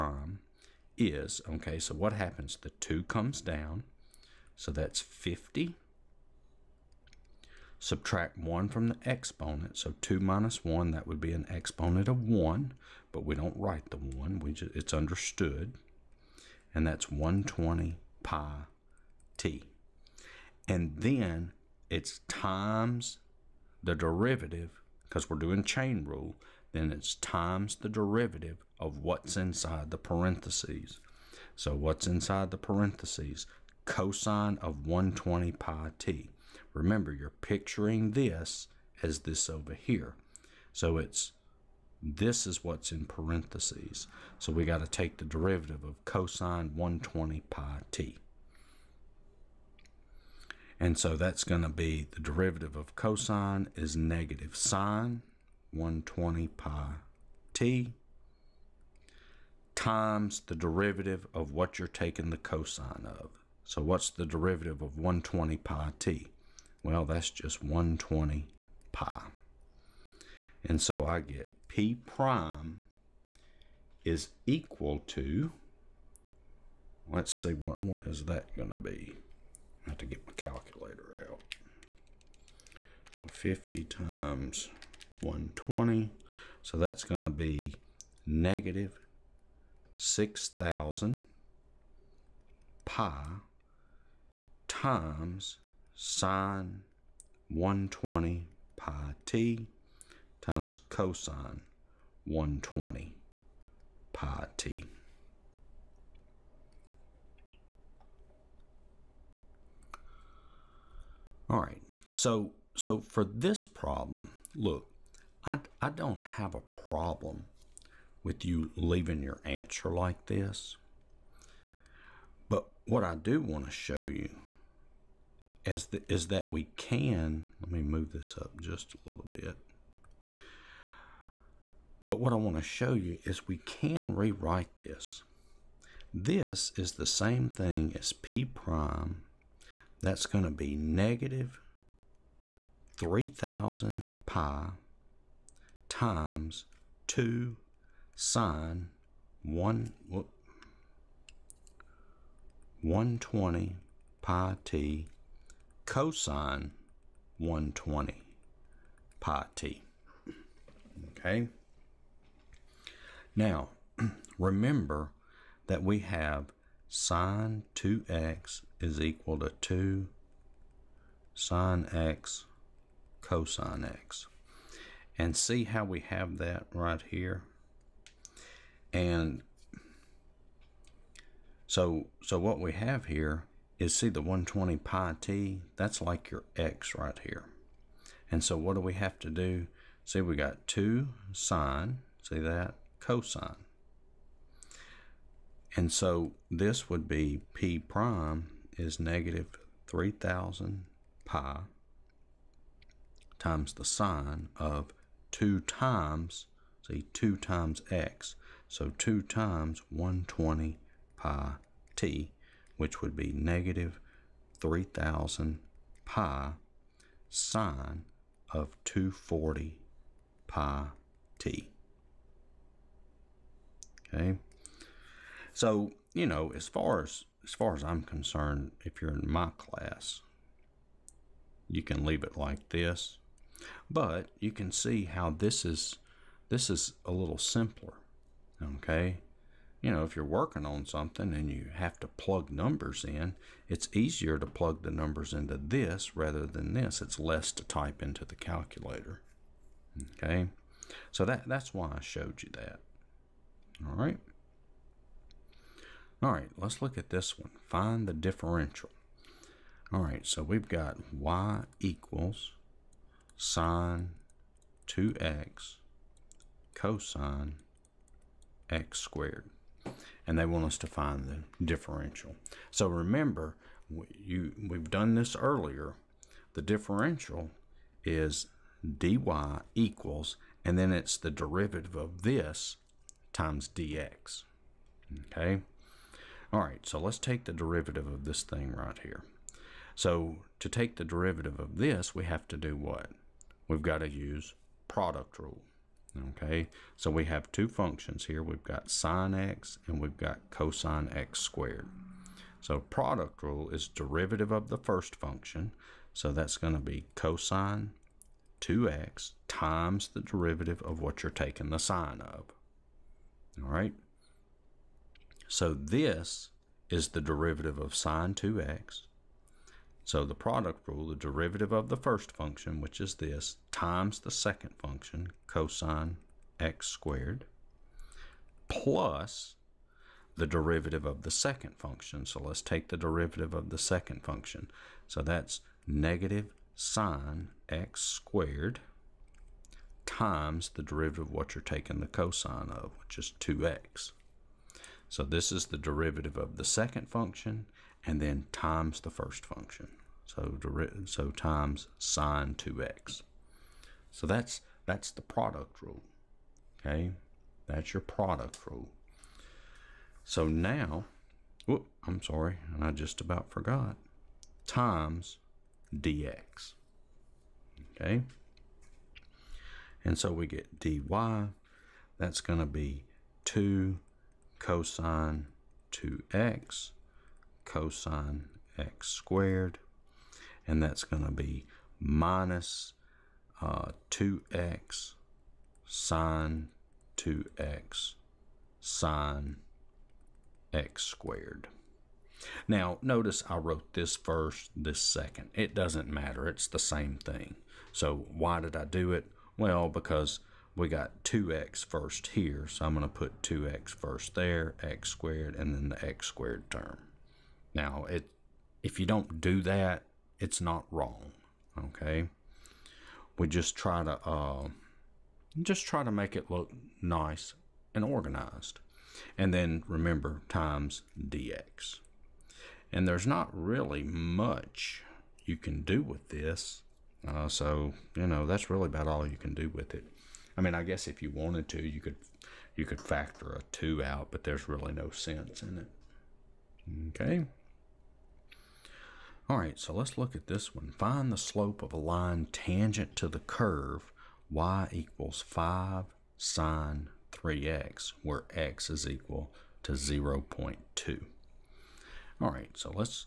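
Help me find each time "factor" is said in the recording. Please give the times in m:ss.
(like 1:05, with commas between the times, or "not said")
7:13.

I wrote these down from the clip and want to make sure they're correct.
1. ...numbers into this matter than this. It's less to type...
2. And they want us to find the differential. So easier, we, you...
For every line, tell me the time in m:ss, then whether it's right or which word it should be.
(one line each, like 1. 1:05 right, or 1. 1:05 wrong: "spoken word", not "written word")
1. 4:04 wrong: "rather", not "matter"
2. 4:30 wrong: "remember", not "easier".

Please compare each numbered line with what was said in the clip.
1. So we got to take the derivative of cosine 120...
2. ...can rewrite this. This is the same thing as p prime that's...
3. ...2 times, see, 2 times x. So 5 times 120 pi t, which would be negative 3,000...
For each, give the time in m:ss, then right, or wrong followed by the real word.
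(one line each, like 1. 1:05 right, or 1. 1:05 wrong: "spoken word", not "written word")
1. 0:44 right
2. 2:13 right
3. 3:25 wrong: "2", not "5".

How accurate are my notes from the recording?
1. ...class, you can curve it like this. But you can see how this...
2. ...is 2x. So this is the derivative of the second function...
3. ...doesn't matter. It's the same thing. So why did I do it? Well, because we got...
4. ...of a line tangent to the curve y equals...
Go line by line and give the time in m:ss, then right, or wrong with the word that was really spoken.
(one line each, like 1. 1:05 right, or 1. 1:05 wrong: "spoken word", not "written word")
1. 3:49 wrong: "leave", not "curve"
2. 5:43 right
3. 6:35 right
4. 7:21 right.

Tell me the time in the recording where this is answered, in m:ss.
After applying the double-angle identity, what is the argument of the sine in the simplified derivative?
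3:38.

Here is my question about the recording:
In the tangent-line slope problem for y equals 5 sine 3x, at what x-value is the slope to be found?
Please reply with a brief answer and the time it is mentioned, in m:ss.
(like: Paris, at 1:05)
0.2, at 7:29.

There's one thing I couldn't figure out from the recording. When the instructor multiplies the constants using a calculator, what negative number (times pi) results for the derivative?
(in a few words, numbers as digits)
-6000.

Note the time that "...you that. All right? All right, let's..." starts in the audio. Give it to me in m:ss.
4:12.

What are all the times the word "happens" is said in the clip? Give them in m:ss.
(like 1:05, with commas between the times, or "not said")
0:02.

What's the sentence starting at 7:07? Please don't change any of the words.
Uh, so, you know, that's really about all you can do with it.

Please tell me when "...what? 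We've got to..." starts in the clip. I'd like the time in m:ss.
4:52.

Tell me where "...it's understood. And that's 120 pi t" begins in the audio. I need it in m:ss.
0:14.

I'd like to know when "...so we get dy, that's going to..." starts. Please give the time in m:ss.
6:10.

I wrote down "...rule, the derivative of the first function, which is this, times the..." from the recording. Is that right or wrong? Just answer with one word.
right.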